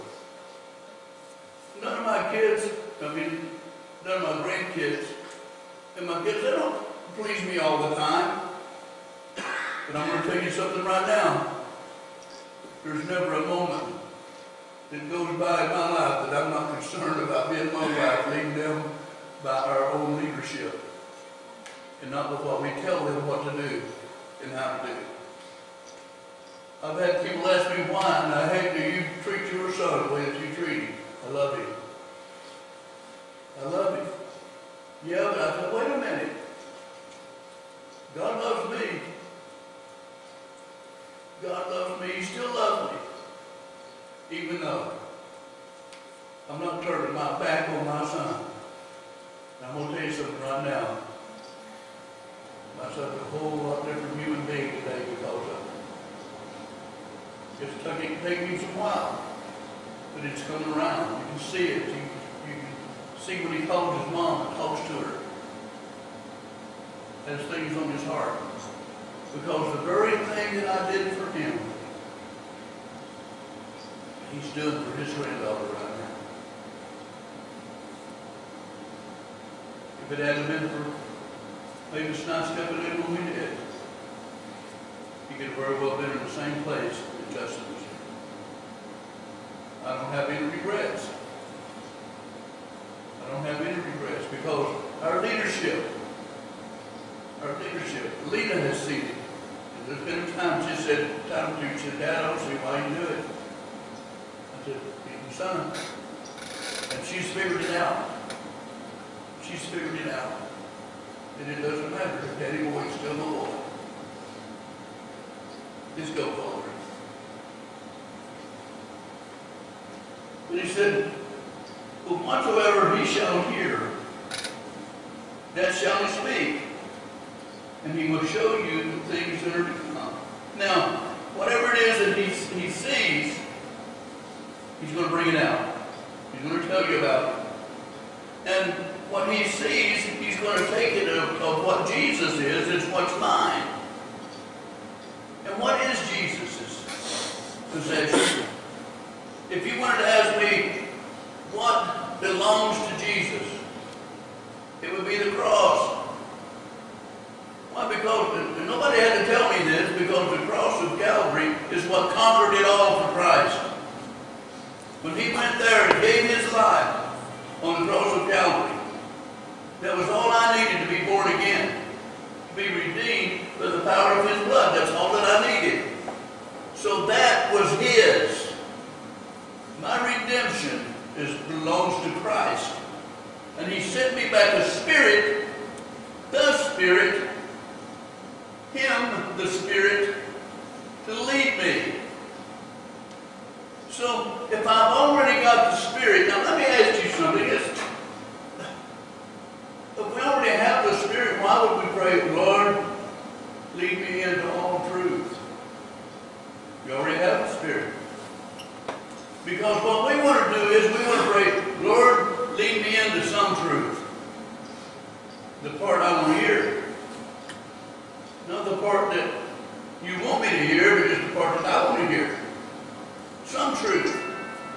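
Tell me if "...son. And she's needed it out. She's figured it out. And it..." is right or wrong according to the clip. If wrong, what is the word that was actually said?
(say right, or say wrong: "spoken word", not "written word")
wrong: "figured", not "needed".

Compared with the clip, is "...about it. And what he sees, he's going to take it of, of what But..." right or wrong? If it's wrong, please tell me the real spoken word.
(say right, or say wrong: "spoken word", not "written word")
wrong: "Jesus", not "But".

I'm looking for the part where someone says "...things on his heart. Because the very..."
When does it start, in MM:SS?
01:07.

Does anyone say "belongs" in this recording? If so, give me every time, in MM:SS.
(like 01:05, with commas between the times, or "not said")
02:32, 03:01.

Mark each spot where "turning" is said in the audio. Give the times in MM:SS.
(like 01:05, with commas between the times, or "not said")
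00:46.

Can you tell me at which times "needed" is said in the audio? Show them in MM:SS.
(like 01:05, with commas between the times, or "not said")
02:50, 02:55.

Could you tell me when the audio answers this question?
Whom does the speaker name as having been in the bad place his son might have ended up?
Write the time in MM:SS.
01:27.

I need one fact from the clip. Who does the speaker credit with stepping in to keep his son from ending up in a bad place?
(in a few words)
Levis.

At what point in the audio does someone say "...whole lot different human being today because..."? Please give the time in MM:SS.
00:53.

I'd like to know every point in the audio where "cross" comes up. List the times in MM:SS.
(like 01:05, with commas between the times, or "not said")
02:35, 02:40, 02:47.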